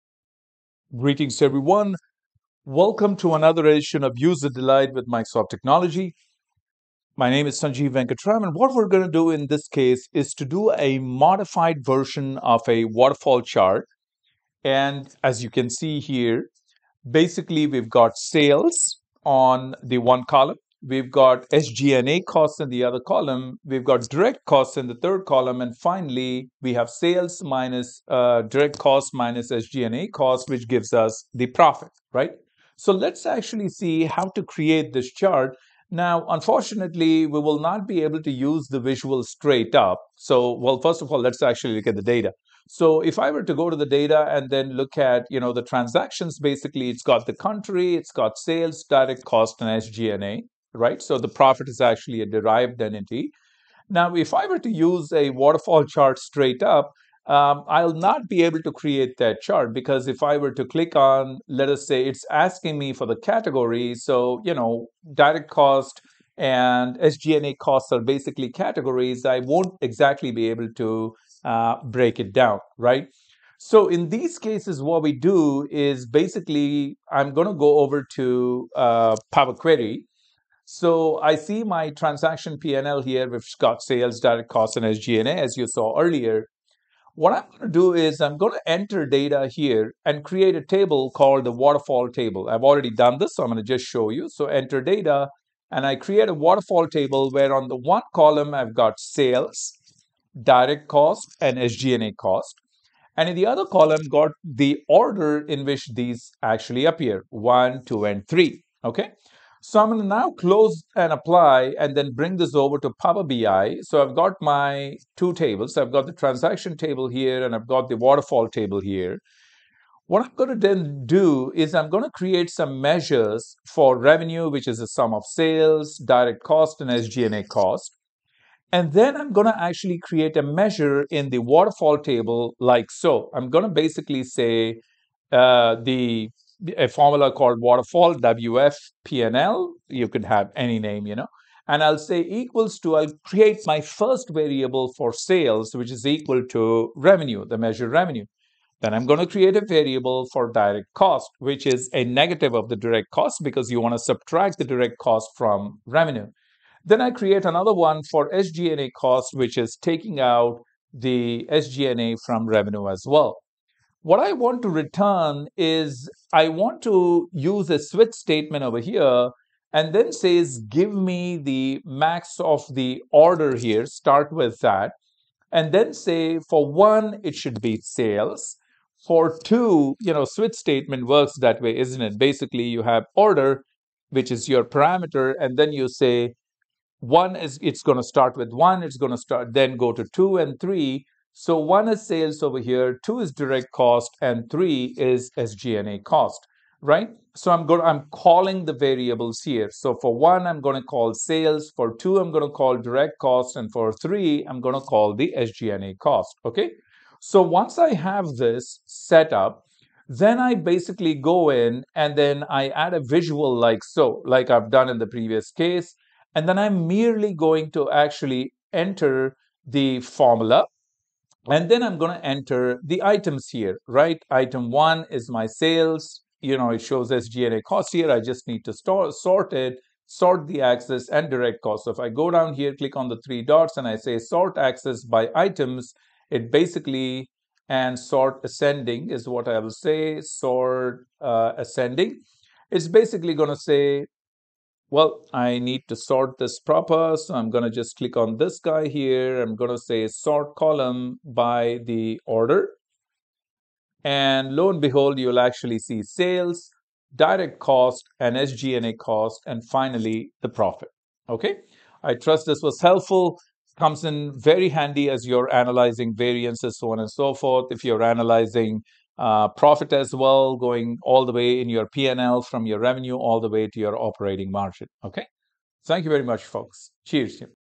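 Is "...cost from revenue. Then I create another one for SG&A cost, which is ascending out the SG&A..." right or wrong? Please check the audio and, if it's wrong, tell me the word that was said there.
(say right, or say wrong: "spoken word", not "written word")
wrong: "taking", not "ascending".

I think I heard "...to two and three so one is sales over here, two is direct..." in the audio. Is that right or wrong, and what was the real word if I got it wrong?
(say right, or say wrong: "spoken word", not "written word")
right.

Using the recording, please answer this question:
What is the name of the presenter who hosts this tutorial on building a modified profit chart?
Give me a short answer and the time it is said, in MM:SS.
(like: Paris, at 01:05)
Sanjiv Venkatram, at 00:07.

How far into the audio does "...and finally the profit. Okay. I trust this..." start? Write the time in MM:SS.
04:19.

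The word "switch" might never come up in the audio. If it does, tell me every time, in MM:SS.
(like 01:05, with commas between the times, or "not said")
02:47, 03:00.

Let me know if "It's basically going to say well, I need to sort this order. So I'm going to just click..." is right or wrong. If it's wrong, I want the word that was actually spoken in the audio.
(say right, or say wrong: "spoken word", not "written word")
wrong: "proper", not "order".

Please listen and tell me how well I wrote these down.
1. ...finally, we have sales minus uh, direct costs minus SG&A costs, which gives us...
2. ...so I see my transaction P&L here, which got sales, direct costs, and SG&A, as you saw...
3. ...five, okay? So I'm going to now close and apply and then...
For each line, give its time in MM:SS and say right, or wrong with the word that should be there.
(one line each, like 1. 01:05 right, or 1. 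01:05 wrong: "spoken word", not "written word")
1. 00:25 right
2. 01:20 right
3. 01:48 wrong: "three", not "five".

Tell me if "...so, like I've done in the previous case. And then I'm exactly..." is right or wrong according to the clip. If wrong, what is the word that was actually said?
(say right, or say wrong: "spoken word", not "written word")
wrong: "merely", not "exactly".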